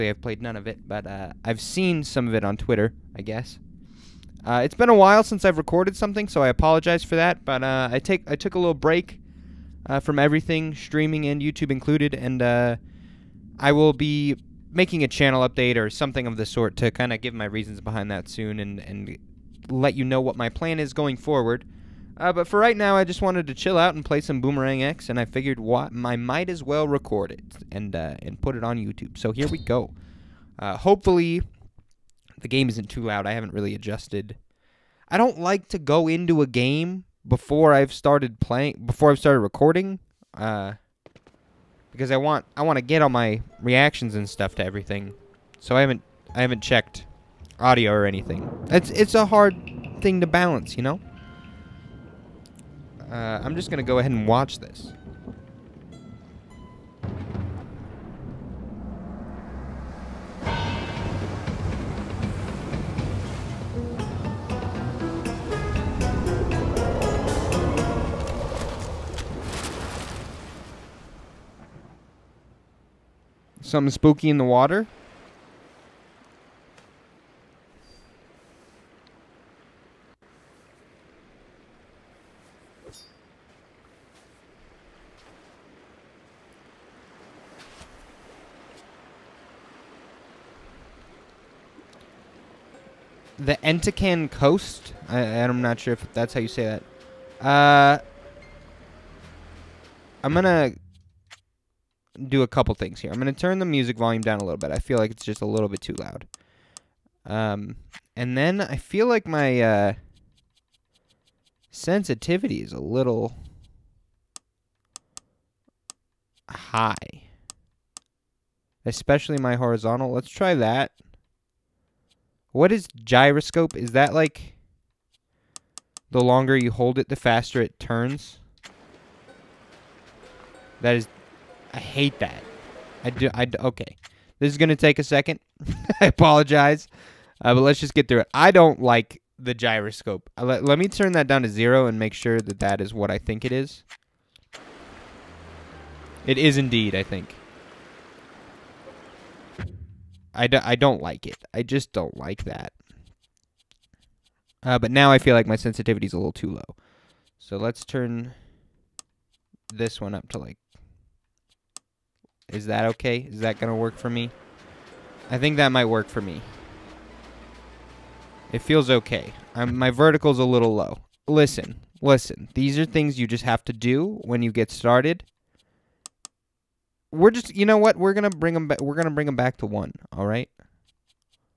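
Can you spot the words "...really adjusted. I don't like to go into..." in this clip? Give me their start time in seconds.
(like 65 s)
33 s.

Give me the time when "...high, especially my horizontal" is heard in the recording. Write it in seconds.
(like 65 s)
116 s.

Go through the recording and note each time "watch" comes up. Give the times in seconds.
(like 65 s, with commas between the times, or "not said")
54 s.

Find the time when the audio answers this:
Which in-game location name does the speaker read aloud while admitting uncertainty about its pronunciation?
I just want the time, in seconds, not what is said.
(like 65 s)
93 s.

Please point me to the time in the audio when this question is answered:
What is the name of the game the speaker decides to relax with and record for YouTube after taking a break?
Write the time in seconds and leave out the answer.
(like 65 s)
24 s.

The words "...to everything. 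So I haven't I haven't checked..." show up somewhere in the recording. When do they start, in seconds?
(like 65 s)
44 s.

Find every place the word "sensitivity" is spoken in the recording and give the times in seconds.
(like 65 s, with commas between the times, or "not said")
111 s, 155 s.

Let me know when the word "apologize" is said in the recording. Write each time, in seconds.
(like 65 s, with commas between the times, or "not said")
6 s, 136 s.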